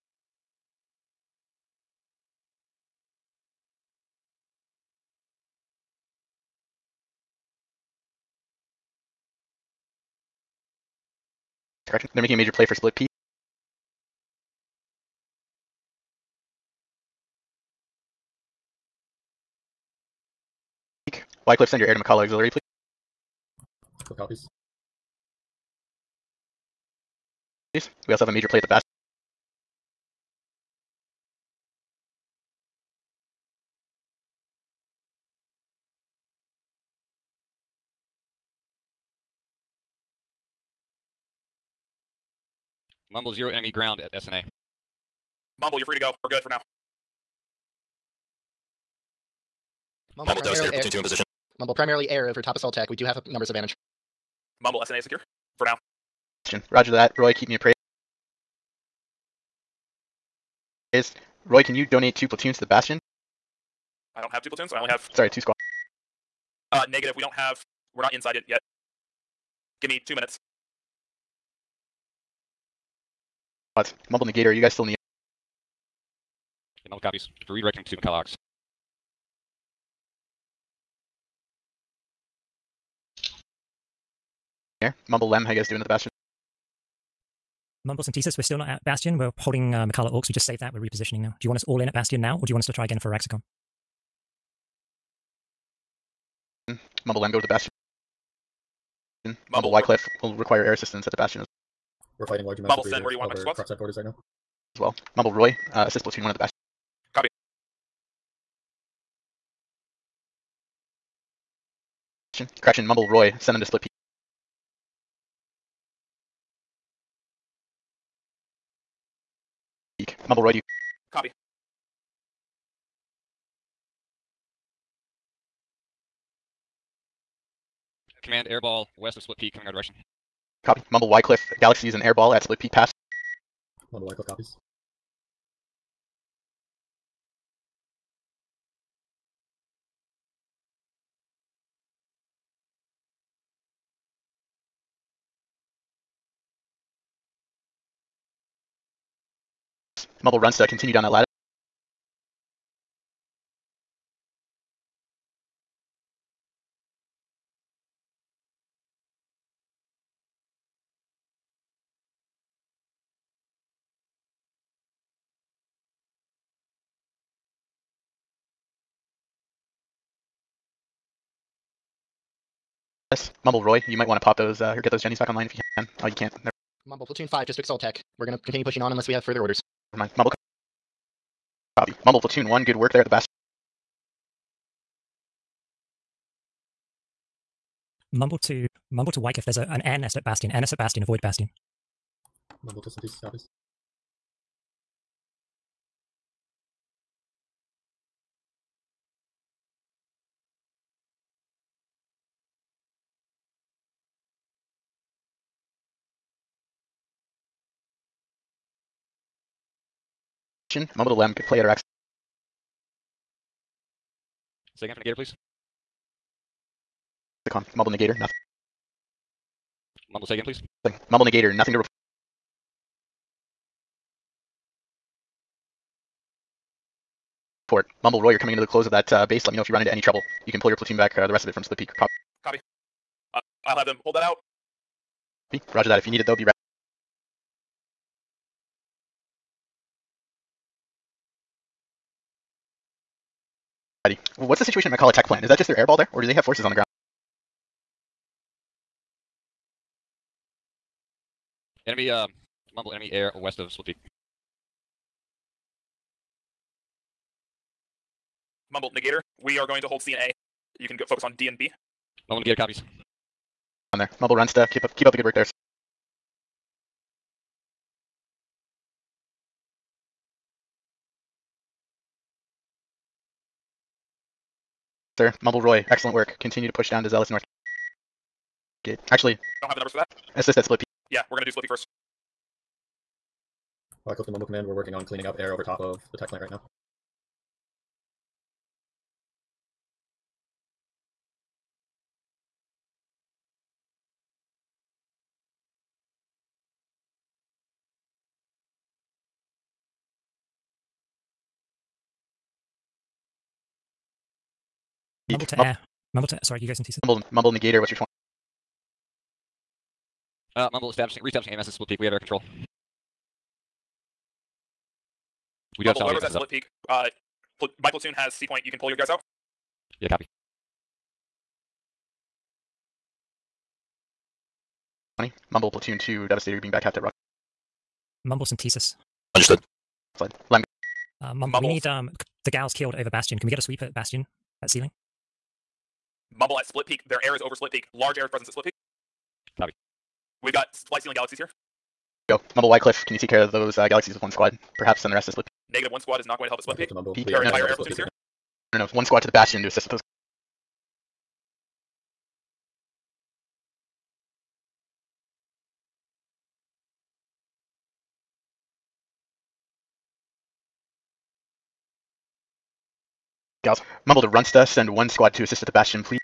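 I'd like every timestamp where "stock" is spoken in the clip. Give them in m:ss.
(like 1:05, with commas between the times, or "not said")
not said.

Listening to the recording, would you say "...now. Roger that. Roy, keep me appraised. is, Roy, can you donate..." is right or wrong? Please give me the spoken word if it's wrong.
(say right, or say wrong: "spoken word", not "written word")
right.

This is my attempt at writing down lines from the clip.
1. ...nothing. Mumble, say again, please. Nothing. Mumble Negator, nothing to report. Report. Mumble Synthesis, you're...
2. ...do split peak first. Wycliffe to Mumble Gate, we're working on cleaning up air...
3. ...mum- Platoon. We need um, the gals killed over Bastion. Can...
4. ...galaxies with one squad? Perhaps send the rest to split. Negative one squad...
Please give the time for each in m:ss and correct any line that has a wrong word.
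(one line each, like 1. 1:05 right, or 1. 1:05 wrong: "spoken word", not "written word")
1. 3:38 wrong: "Roy", not "Synthesis"
2. 4:41 wrong: "Command", not "Gate"
3. 5:31 wrong: "Mumble", not "Platoon"
4. 5:43 right.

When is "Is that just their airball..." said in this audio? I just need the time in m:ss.
4:05.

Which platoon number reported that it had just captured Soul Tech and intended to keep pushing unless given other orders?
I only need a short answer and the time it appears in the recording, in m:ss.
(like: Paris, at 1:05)
5, at 2:57.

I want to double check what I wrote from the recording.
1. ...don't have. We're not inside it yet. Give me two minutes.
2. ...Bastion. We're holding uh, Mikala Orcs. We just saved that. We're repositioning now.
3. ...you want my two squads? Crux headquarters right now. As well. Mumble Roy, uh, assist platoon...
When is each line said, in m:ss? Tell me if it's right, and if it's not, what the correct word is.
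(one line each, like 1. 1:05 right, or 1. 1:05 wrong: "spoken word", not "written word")
1. 1:07 right
2. 1:28 right
3. 1:43 right.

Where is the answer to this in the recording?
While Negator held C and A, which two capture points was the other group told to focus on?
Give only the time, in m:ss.
4:21.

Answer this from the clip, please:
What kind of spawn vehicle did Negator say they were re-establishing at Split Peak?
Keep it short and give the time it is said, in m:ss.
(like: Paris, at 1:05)
AMS, at 5:11.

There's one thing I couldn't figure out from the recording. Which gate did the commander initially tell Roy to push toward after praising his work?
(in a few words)
Zealous North Gate.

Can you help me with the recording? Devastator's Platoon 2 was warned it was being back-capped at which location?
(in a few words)
Rock.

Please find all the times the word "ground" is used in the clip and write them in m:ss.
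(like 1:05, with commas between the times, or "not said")
0:43, 4:06.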